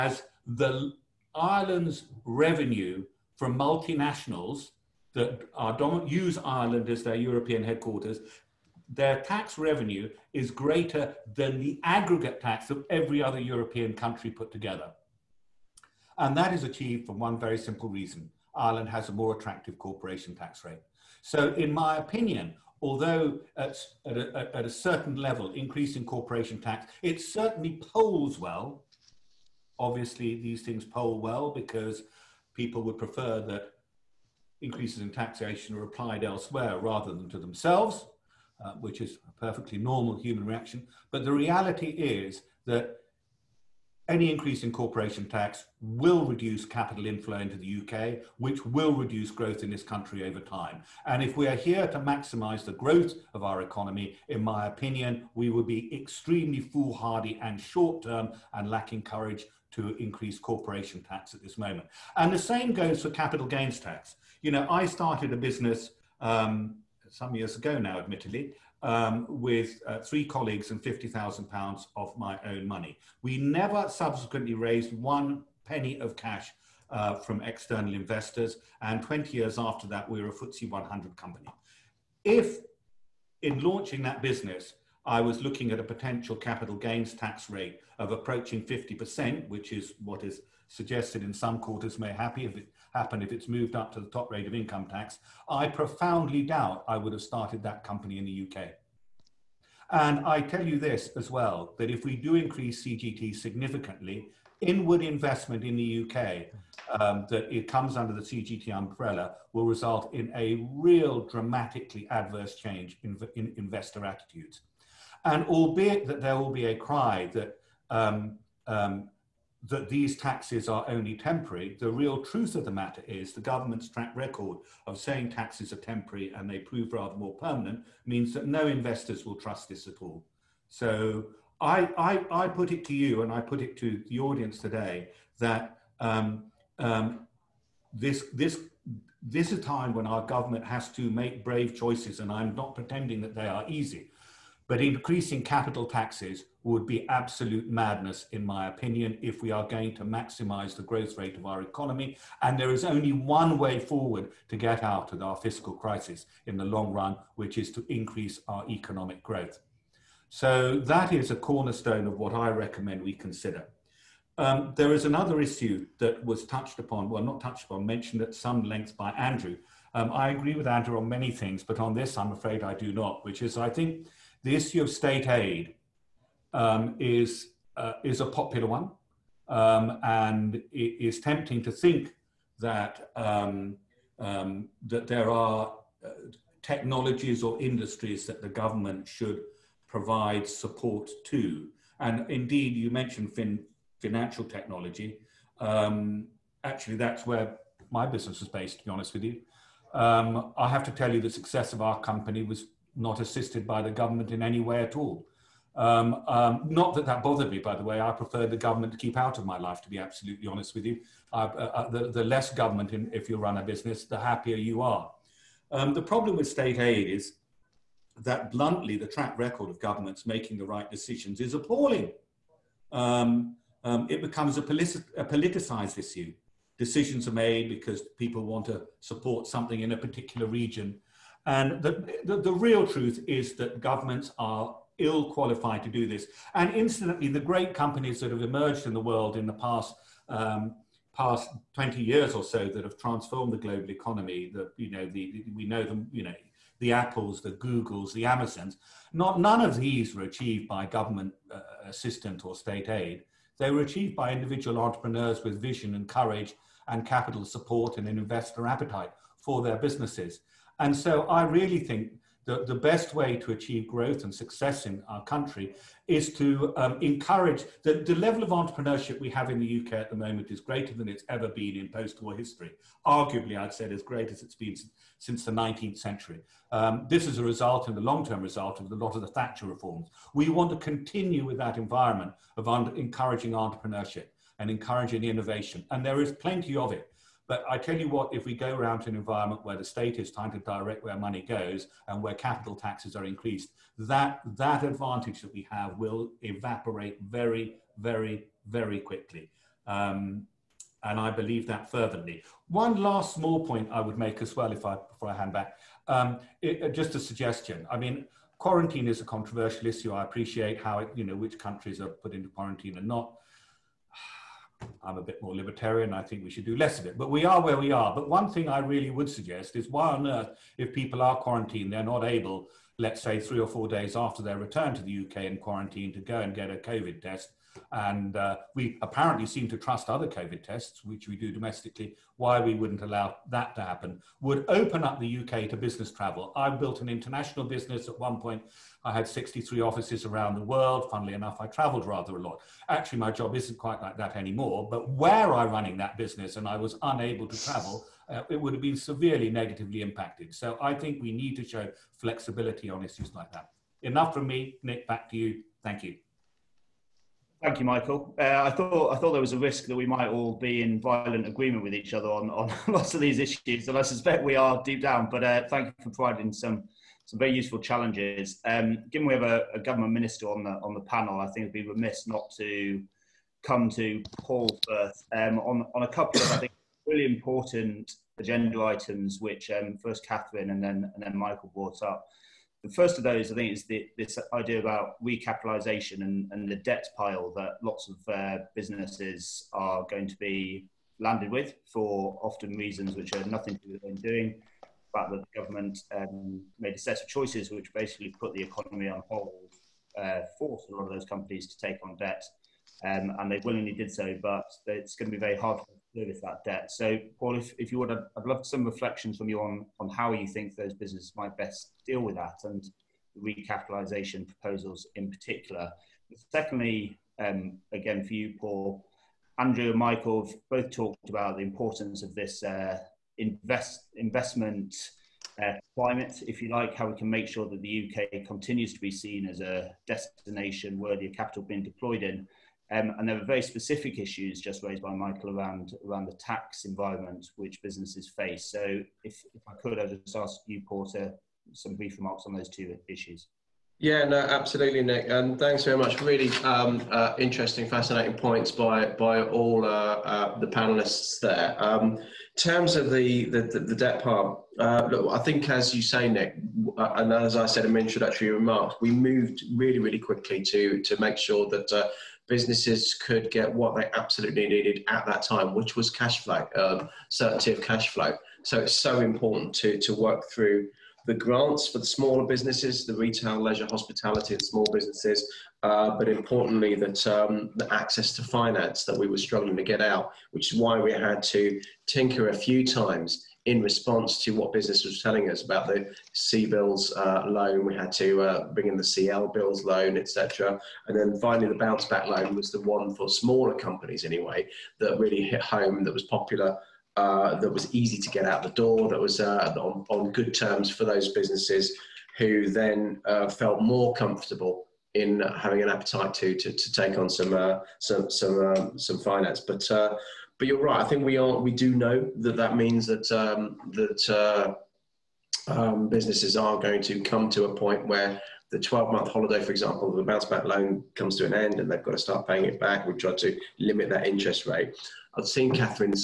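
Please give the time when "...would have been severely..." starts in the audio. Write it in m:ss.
5:48.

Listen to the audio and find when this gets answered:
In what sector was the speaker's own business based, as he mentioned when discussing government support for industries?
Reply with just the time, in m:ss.
3:13.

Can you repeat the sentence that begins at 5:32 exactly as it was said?
Why we wouldn't allow that to happen would open up the UK to business travel.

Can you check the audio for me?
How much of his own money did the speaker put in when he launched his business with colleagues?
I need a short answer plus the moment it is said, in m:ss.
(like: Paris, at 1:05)
£50,000, at 1:10.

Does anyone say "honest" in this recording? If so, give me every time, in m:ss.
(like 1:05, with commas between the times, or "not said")
3:18, 3:30.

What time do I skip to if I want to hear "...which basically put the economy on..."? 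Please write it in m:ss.
6:37.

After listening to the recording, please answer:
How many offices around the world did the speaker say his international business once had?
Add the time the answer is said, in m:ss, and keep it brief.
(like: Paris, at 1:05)
63, at 5:39.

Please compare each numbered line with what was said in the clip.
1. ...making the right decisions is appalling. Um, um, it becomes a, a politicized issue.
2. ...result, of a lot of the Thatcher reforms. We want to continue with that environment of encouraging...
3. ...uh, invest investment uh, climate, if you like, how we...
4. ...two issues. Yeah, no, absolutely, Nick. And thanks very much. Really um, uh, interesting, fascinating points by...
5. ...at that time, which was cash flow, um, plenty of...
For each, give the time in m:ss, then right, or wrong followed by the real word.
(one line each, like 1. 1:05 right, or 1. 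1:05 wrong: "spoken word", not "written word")
1. 3:40 right
2. 4:38 right
3. 7:02 right
4. 7:22 right
5. 7:45 wrong: "certainty", not "plenty".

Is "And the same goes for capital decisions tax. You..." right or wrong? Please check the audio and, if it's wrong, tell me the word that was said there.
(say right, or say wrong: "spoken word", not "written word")
wrong: "gains", not "decisions".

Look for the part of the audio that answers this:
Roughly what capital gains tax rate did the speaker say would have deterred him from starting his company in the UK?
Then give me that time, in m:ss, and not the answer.
1:28.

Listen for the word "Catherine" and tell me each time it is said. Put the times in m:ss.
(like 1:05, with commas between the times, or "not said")
6:20, 8:45.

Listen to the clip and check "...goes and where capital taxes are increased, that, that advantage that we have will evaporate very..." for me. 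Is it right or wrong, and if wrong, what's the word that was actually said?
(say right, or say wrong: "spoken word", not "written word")
right.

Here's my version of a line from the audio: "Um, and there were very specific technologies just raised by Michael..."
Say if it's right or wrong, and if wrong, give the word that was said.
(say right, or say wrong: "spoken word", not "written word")
wrong: "issues", not "technologies".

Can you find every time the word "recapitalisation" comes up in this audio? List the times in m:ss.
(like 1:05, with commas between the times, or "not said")
6:25, 6:53.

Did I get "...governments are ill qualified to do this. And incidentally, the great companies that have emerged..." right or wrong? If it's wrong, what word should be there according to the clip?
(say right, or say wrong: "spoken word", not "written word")
right.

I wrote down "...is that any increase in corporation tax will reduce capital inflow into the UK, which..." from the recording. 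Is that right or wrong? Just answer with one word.
right.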